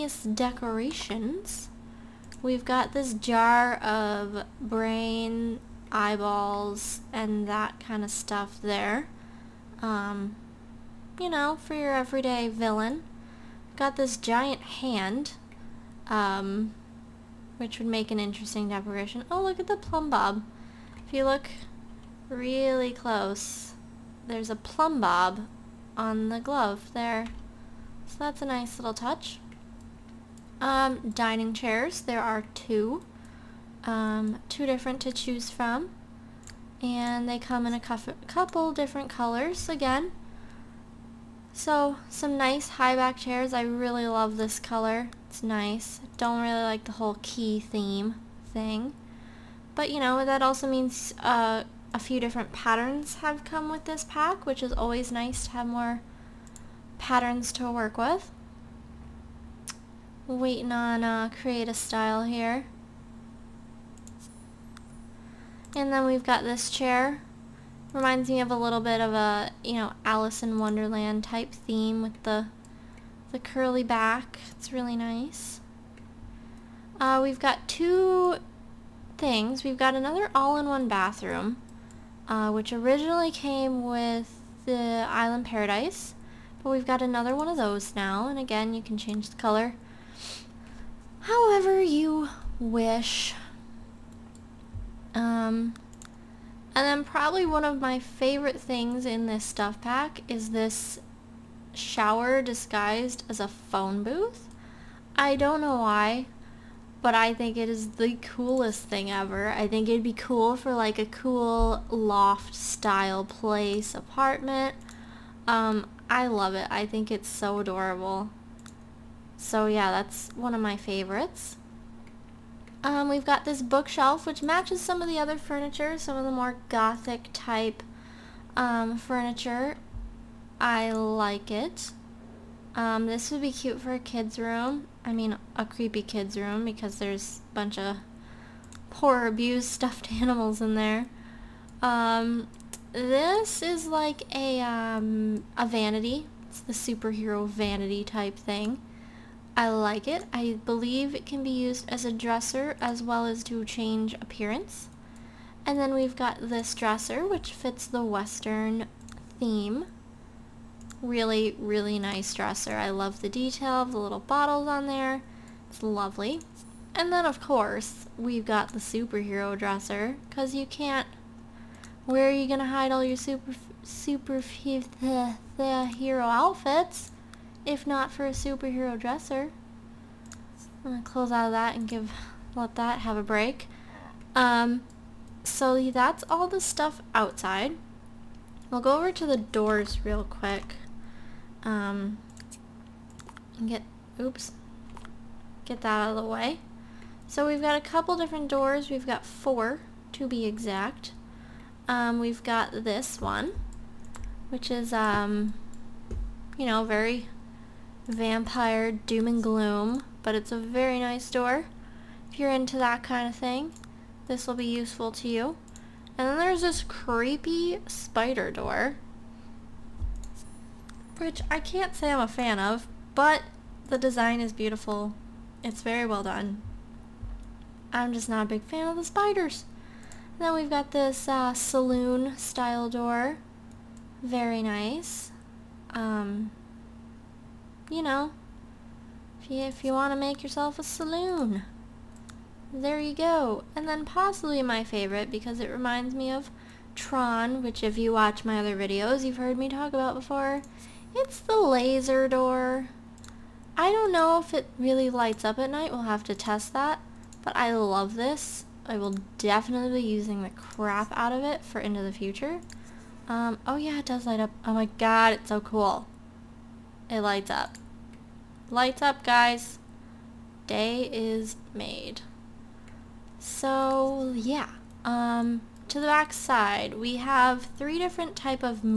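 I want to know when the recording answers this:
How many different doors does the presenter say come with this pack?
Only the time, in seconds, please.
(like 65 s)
199 s.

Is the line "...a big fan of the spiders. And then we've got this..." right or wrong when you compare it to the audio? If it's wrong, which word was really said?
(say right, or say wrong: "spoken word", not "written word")
right.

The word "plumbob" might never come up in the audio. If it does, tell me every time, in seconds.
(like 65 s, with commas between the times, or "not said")
19 s, 24 s.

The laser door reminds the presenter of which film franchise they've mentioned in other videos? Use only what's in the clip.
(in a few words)
Tron.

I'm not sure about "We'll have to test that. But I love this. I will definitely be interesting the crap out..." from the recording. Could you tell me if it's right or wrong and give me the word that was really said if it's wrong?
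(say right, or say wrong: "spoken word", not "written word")
wrong: "using", not "interesting".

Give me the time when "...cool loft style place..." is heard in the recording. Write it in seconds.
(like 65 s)
111 s.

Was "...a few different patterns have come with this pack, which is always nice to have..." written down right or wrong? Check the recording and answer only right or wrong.
right.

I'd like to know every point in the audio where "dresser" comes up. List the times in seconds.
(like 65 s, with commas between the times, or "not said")
152 s, 156 s, 162 s, 169 s, 178 s.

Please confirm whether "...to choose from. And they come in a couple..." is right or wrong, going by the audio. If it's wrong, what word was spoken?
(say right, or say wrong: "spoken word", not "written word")
right.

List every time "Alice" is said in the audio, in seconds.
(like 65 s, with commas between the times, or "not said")
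70 s.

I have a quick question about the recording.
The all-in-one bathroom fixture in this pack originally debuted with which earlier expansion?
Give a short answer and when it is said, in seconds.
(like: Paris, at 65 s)
Island Paradise, at 85 s.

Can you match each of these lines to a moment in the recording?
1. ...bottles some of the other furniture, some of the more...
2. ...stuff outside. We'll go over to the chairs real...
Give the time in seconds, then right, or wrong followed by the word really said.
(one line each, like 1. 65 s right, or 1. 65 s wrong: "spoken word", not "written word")
1. 124 s wrong: "matches", not "bottles"
2. 186 s wrong: "doors", not "chairs".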